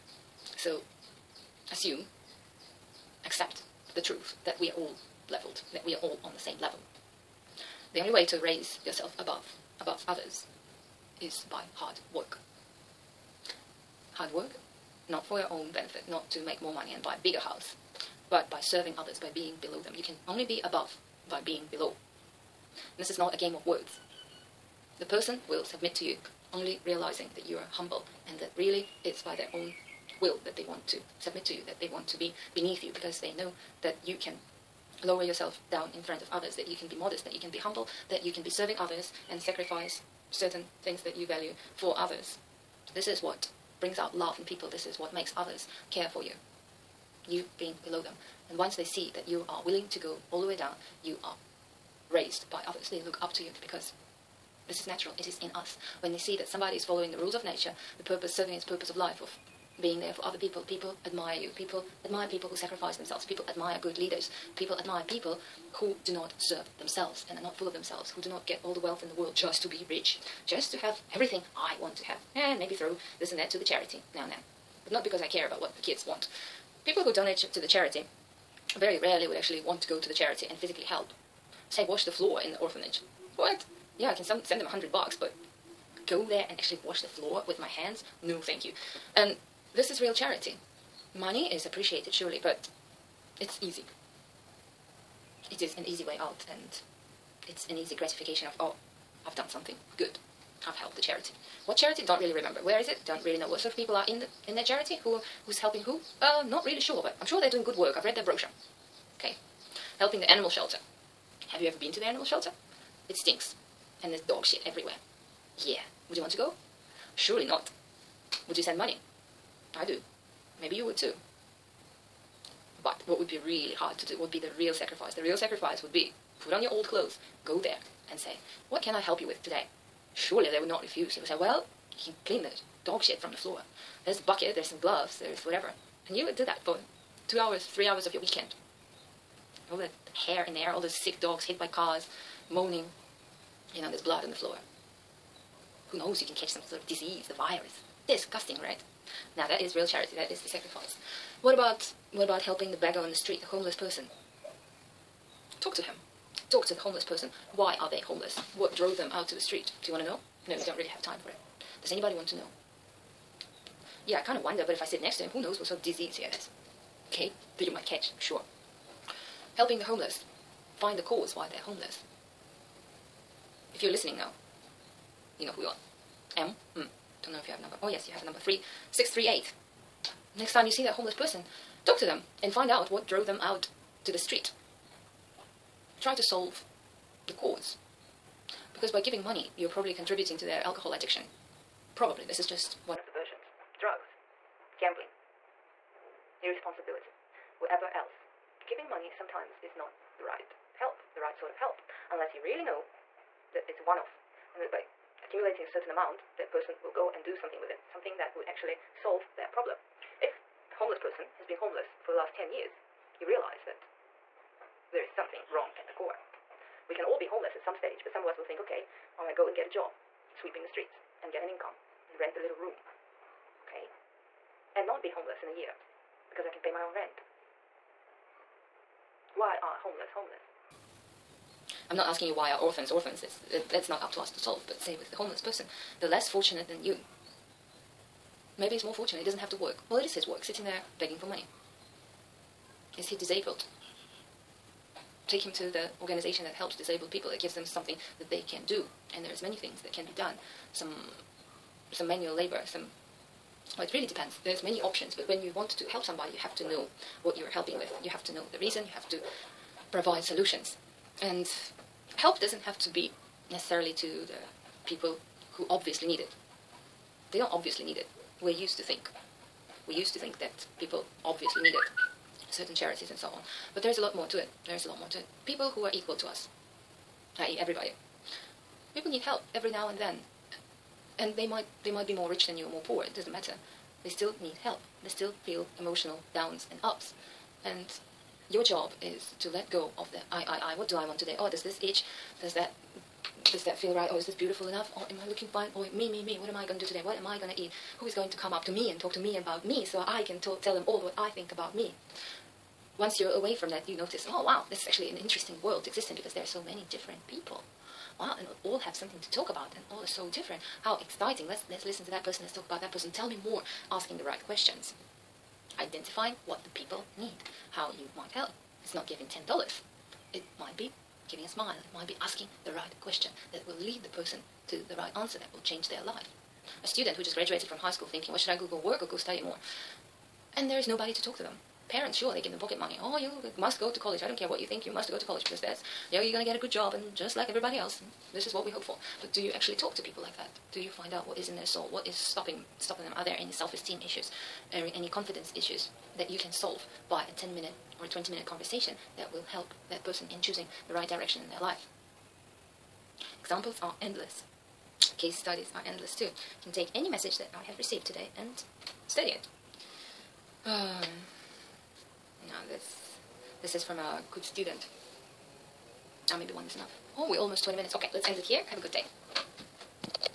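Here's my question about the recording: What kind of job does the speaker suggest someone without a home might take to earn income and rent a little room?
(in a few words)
sweeping the streets.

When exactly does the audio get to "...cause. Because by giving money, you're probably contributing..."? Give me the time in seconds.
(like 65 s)
187 s.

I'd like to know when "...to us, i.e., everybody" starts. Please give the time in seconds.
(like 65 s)
276 s.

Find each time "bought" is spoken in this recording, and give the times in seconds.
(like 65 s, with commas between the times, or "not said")
not said.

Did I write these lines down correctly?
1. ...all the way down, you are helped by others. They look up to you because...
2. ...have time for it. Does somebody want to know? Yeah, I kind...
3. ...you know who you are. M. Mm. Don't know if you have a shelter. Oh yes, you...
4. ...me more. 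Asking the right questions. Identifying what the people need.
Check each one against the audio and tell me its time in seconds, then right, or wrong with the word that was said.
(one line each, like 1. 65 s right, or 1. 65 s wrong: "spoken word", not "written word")
1. 50 s wrong: "raised", not "helped"
2. 160 s wrong: "anybody", not "somebody"
3. 175 s wrong: "number", not "shelter"
4. 313 s right.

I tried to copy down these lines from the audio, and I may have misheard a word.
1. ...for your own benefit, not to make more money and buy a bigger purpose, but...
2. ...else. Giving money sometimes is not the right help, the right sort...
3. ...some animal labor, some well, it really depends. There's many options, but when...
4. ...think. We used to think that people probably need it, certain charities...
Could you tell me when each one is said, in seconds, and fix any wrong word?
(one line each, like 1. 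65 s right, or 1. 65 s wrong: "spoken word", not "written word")
1. 15 s wrong: "house", not "purpose"
2. 197 s right
3. 251 s wrong: "manual", not "animal"
4. 268 s wrong: "obviously", not "probably".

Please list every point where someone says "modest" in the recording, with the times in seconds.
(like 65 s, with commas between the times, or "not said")
36 s.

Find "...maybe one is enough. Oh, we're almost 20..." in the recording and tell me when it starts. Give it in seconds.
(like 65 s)
366 s.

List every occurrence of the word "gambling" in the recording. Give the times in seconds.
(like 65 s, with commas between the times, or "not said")
194 s.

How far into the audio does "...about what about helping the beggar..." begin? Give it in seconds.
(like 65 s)
151 s.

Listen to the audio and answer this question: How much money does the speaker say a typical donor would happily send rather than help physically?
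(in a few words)
100 bucks.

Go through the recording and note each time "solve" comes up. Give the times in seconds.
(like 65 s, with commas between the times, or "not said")
186 s, 208 s, 234 s, 346 s.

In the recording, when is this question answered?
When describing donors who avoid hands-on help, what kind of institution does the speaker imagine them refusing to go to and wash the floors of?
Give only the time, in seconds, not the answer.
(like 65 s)
82 s.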